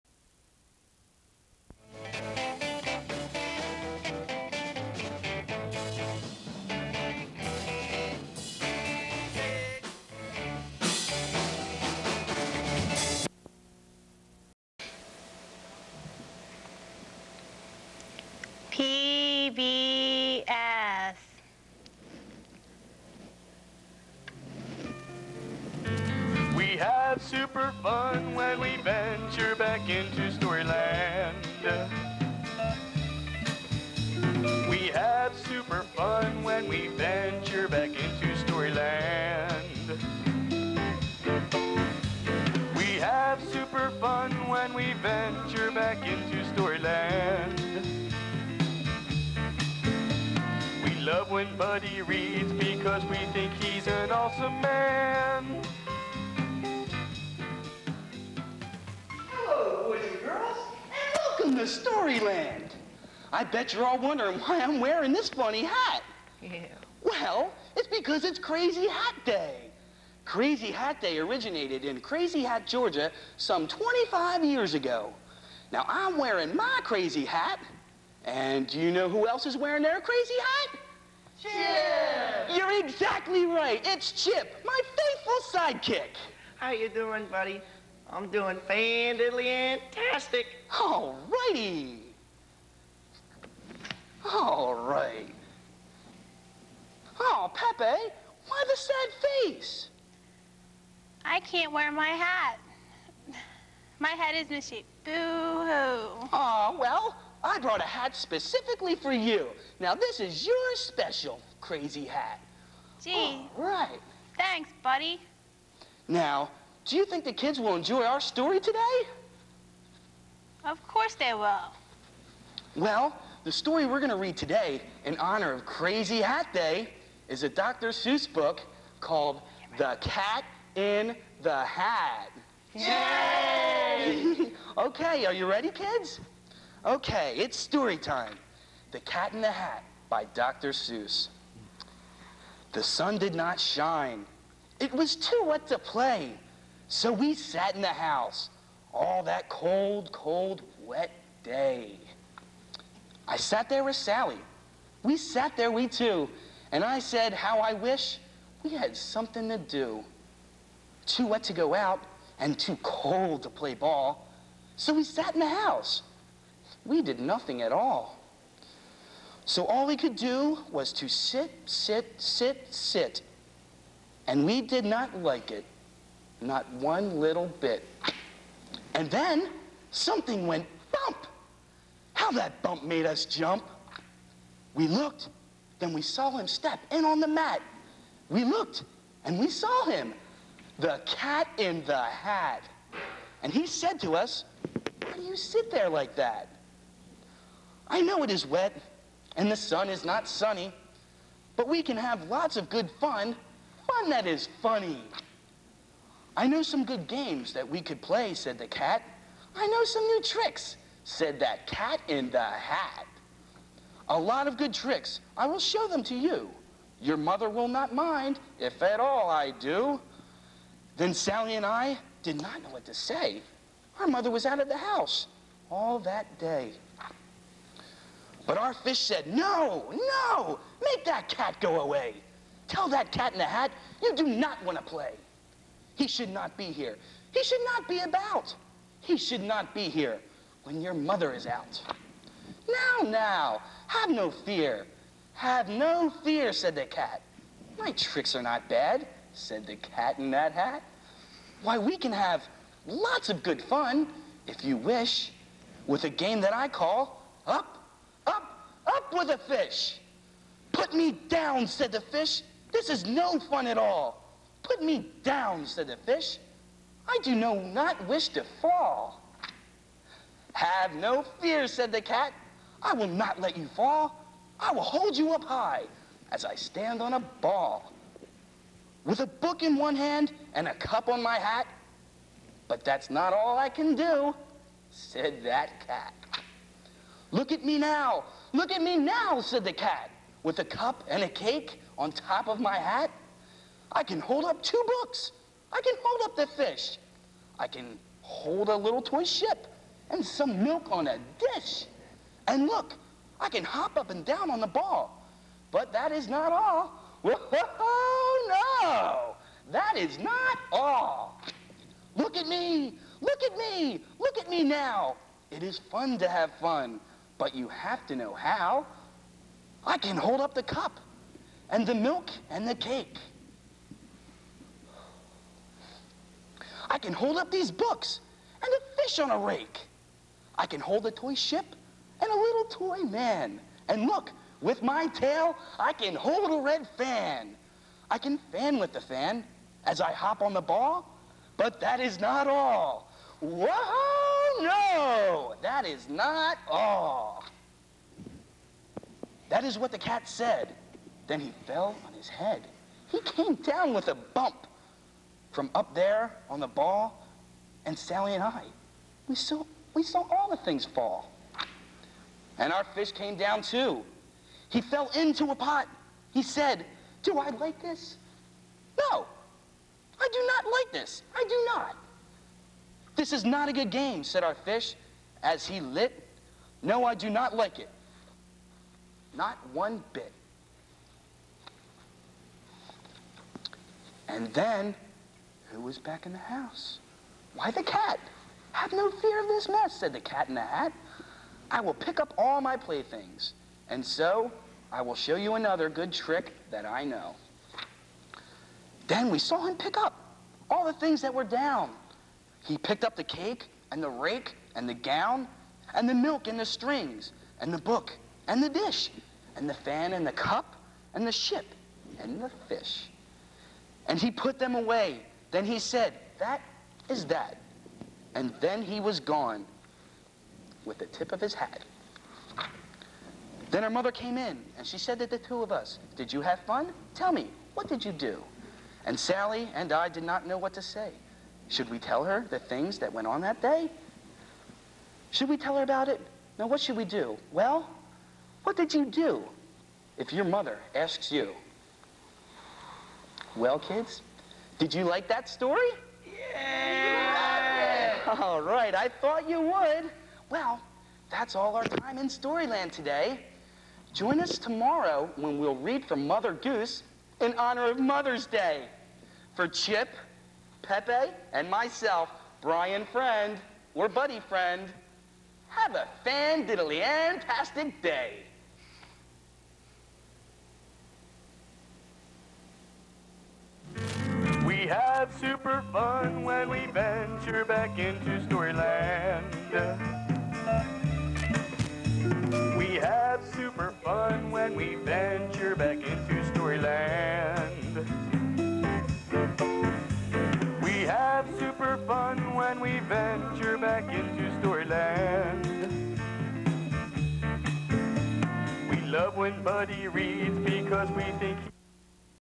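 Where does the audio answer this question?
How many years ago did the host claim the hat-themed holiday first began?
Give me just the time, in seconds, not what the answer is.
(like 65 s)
73 s.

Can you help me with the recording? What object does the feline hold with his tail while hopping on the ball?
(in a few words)
A red fan.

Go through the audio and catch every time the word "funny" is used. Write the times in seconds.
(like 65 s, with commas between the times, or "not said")
65 s, 204 s.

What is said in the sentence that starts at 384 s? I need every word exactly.
And then, who was back in the house?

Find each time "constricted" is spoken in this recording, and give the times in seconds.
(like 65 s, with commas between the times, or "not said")
not said.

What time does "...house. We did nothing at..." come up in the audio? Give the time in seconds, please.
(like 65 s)
165 s.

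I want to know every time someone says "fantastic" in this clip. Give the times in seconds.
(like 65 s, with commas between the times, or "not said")
88 s, 467 s.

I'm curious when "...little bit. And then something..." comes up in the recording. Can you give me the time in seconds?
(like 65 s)
177 s.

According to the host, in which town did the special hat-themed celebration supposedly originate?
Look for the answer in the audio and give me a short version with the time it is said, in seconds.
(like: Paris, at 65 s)
Crazy Hat, Georgia, at 72 s.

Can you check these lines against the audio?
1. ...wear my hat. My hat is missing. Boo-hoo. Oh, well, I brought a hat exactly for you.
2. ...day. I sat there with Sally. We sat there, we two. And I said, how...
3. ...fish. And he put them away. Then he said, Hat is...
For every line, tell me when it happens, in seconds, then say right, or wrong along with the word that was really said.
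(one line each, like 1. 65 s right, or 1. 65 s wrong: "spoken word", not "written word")
1. 101 s wrong: "specifically", not "exactly"
2. 151 s right
3. 412 s wrong: "That", not "Hat".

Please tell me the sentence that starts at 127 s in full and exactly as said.
Seuss book called The Cat in the Hat.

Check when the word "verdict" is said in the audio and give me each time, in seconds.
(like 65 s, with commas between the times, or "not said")
not said.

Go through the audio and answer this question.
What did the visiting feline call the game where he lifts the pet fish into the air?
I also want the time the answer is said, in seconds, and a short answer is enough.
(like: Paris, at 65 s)
Up up with the fish, at 257 s.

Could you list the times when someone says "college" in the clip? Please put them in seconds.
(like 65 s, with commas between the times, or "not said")
not said.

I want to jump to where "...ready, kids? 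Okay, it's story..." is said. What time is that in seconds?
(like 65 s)
135 s.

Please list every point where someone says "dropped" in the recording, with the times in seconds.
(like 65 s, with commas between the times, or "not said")
not said.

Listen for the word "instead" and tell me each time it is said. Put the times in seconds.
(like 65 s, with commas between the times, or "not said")
not said.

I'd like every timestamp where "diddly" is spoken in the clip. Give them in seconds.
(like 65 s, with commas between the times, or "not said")
466 s.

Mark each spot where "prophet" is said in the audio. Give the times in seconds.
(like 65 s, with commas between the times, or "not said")
not said.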